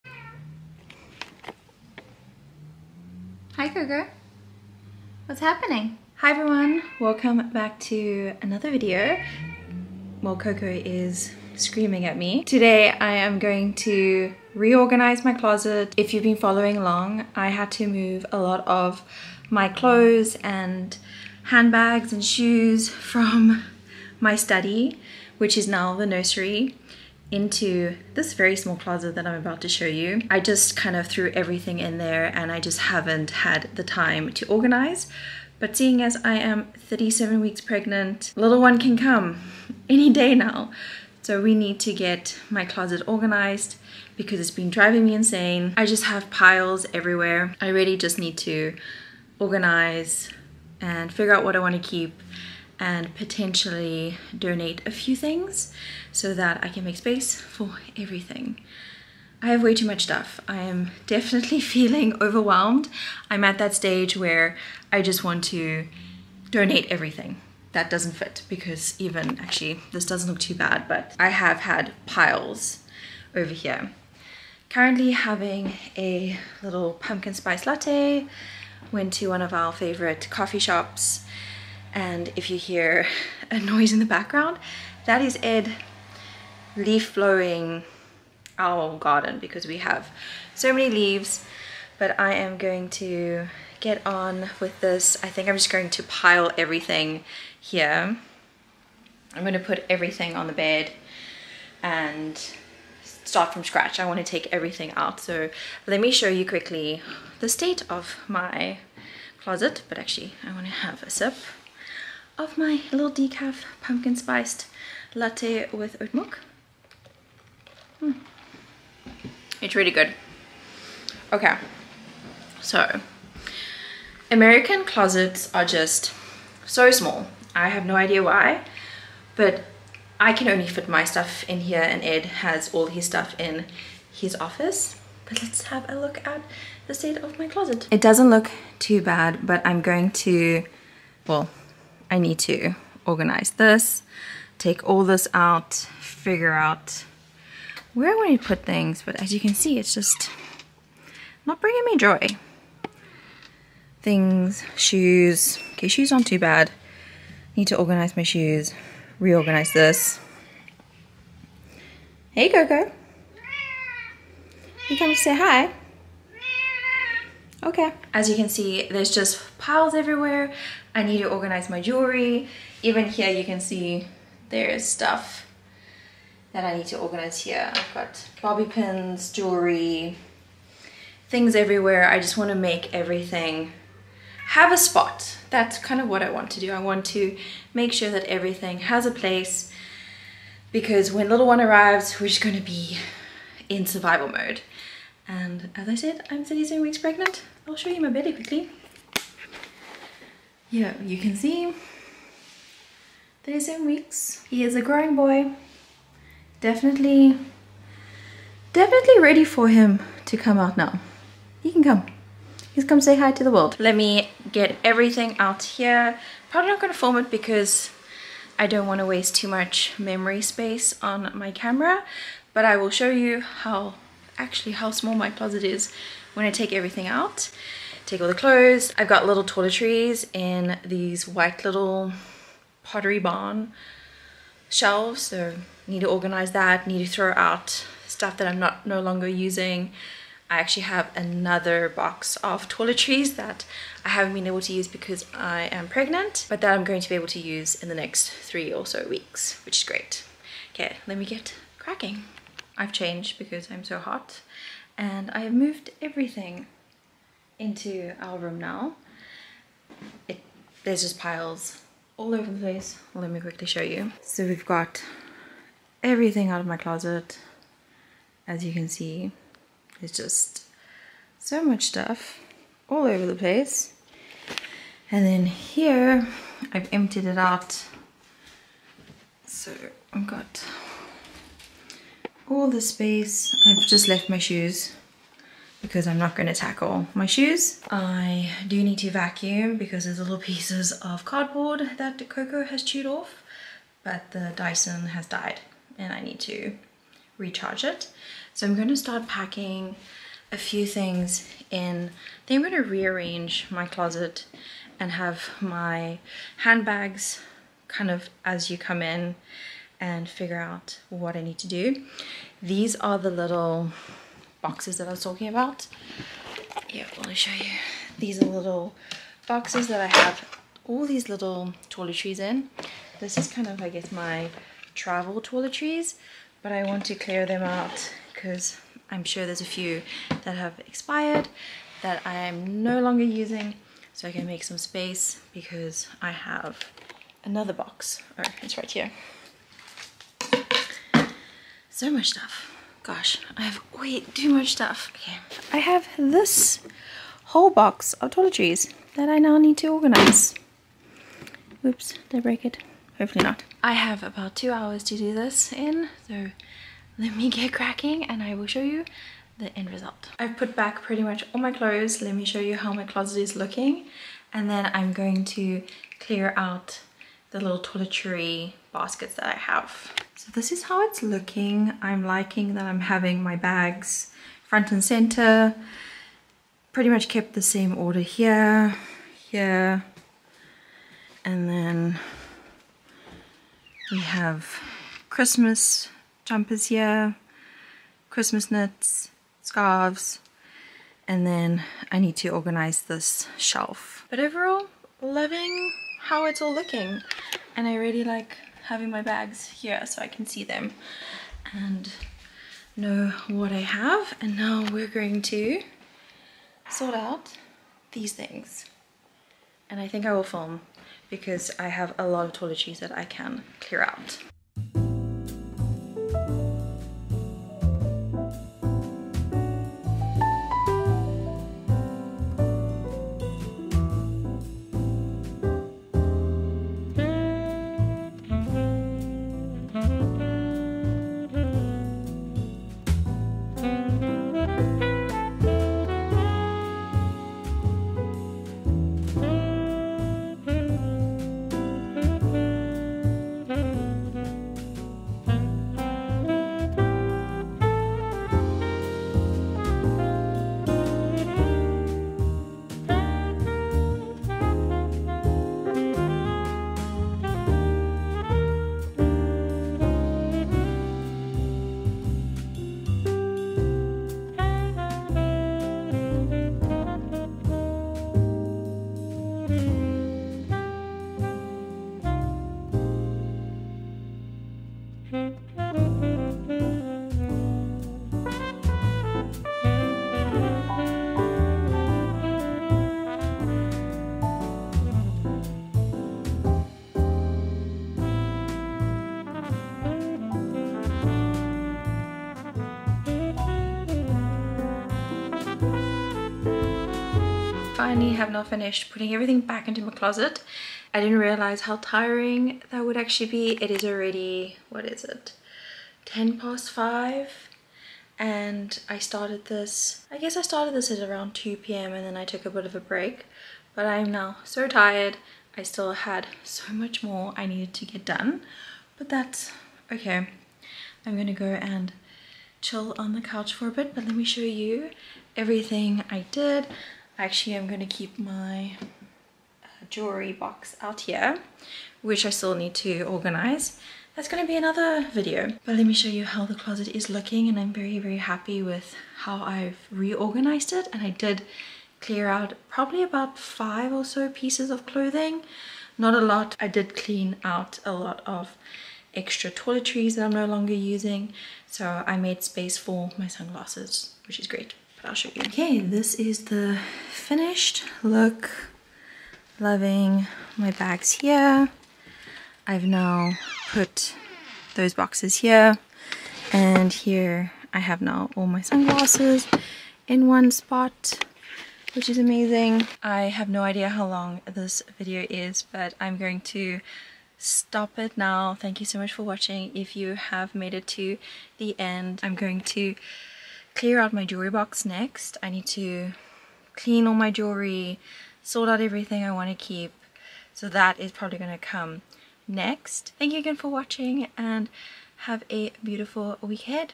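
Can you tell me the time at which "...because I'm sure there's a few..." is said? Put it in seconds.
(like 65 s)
328 s.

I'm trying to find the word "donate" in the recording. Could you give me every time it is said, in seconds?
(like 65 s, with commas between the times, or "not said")
54 s, 66 s.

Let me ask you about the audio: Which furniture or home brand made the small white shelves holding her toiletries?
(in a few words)
Pottery Barn.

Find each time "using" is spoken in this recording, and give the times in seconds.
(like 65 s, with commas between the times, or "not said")
239 s, 333 s, 550 s.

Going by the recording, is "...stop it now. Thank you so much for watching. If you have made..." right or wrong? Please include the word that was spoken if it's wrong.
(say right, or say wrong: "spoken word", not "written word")
right.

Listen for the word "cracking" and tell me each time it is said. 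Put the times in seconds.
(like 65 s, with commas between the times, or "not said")
251 s, 357 s.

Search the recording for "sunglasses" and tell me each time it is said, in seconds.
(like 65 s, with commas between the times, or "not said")
553 s, 568 s.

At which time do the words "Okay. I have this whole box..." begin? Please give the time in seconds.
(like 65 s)
345 s.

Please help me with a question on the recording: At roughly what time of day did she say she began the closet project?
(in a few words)
2 p.m.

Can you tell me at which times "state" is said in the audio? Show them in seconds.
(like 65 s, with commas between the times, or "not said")
107 s, 136 s.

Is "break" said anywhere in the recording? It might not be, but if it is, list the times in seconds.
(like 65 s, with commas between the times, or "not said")
352 s, 512 s.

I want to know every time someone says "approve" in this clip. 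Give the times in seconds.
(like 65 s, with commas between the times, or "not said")
not said.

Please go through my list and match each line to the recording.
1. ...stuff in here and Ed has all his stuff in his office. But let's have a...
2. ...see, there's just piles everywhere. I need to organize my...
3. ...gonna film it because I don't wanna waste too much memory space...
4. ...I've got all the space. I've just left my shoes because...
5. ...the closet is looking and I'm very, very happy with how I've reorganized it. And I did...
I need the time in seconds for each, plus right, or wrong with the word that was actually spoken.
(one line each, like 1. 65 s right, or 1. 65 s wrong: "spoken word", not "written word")
1. 131 s right
2. 168 s right
3. 216 s right
4. 280 s right
5. 536 s right.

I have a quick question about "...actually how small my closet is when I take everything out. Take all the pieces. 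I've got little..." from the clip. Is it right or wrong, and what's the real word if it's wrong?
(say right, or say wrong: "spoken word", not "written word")
wrong: "clothes", not "pieces".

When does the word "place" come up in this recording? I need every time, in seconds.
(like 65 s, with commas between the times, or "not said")
189 s, 262 s, 273 s.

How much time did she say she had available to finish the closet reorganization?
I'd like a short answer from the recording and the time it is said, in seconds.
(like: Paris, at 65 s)
2 hours, at 354 s.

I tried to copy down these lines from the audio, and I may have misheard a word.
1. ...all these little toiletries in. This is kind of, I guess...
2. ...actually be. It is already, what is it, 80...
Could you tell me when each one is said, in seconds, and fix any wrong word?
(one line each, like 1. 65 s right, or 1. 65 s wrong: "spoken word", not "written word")
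1. 320 s right
2. 503 s wrong: "10", not "80".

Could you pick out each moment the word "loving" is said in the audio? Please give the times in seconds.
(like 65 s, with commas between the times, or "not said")
395 s, 559 s.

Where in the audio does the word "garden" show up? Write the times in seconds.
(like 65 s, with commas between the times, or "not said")
88 s.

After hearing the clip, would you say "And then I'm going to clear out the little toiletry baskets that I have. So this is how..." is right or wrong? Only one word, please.
right.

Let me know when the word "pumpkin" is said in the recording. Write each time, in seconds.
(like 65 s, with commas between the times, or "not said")
76 s, 113 s.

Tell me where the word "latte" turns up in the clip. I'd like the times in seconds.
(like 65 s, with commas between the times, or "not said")
77 s, 115 s.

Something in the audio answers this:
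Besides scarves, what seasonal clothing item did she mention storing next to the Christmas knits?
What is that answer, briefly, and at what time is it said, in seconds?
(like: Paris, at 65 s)
Christmas jumpers, at 385 s.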